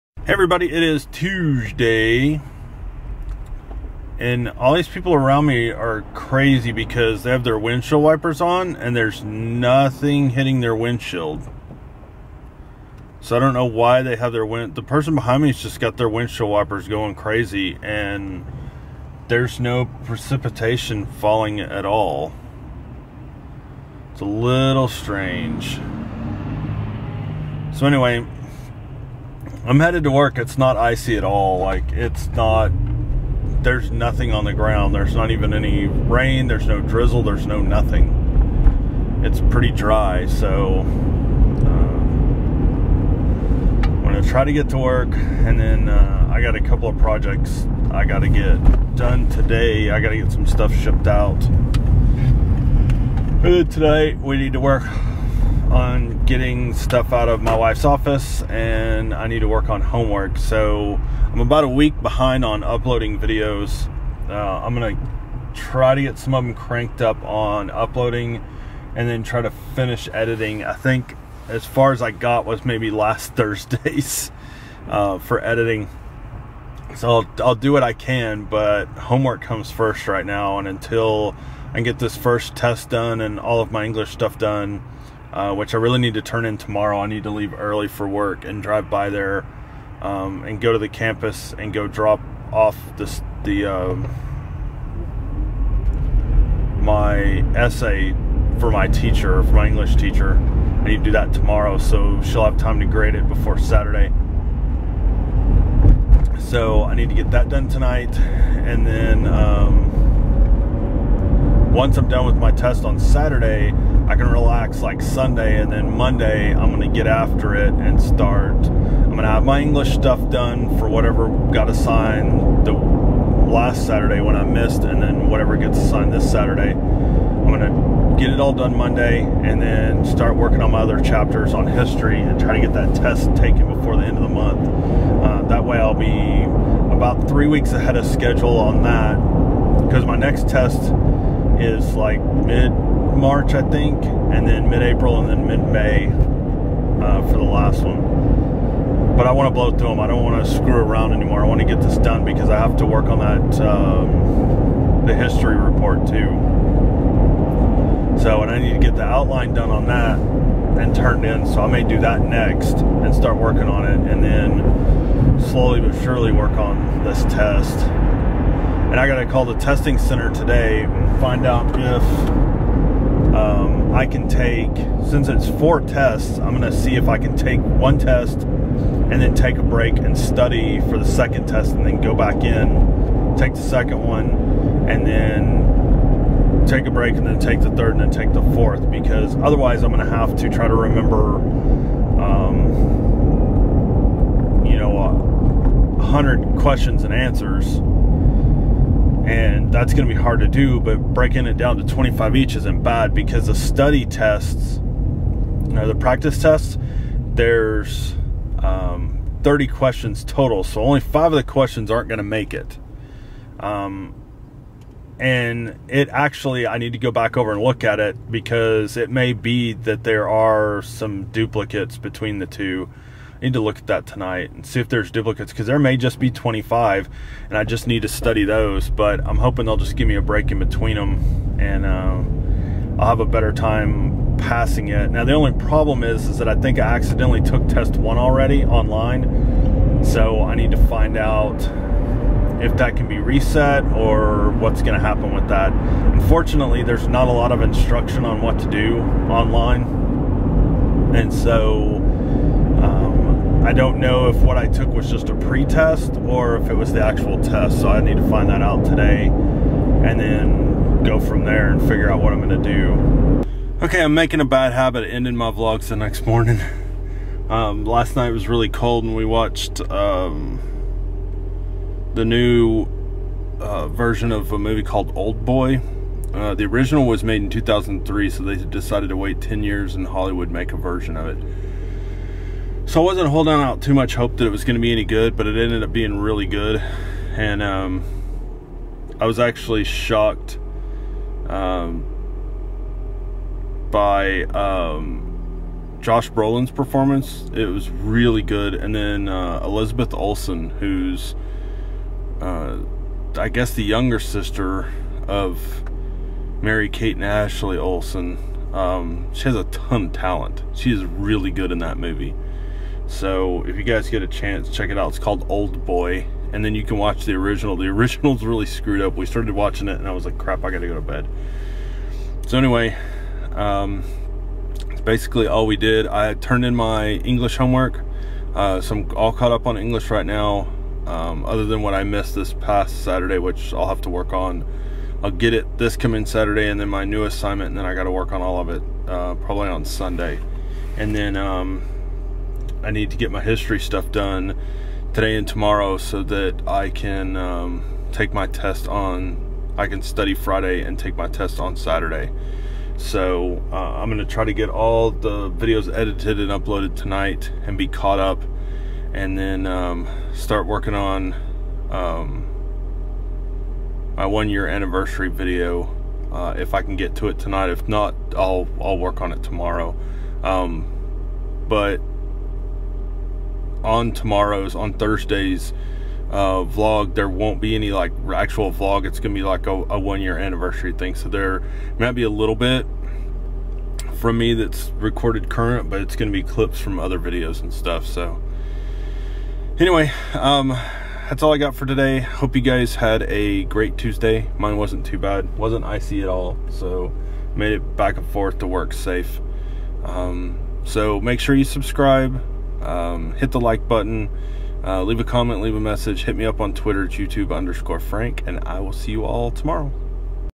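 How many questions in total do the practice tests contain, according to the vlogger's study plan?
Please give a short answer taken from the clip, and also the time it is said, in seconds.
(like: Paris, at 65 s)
30, at 209 s.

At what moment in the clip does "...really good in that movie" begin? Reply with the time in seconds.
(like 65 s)
311 s.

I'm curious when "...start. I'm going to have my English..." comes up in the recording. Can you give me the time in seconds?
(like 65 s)
118 s.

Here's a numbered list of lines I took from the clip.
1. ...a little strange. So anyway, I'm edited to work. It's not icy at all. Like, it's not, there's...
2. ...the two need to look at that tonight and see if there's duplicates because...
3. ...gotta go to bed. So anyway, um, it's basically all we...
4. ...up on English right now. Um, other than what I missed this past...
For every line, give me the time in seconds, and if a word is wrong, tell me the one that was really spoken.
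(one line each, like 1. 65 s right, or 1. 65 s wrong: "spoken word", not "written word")
1. 24 s wrong: "headed", not "edited"
2. 222 s right
3. 320 s right
4. 329 s right.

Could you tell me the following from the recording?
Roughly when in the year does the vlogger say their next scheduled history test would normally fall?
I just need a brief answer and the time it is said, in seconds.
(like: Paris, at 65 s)
mid March, at 142 s.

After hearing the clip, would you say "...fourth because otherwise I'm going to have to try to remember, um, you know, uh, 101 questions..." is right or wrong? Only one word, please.
wrong.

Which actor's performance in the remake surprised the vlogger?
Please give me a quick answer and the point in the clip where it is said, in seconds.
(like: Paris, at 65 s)
Josh Brolin, at 296 s.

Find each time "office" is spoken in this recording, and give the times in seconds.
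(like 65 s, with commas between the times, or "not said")
57 s.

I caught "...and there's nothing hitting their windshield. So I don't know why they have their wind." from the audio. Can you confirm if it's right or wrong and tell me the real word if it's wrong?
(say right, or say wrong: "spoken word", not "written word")
right.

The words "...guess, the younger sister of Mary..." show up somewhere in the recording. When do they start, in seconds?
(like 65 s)
303 s.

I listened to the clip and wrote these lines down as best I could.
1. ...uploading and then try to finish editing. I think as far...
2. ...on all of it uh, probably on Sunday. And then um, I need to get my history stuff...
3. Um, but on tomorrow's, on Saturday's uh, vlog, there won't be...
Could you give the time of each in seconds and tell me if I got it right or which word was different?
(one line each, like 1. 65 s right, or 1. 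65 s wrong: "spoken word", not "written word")
1. 67 s right
2. 338 s right
3. 370 s wrong: "Thursday", not "Saturday".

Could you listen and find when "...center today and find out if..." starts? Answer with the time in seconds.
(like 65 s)
169 s.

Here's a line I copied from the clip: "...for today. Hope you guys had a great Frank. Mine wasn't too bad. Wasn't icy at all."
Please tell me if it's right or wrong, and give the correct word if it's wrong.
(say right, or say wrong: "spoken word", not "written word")
wrong: "Tuesday", not "Frank".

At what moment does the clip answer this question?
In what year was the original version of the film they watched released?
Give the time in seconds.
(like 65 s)
277 s.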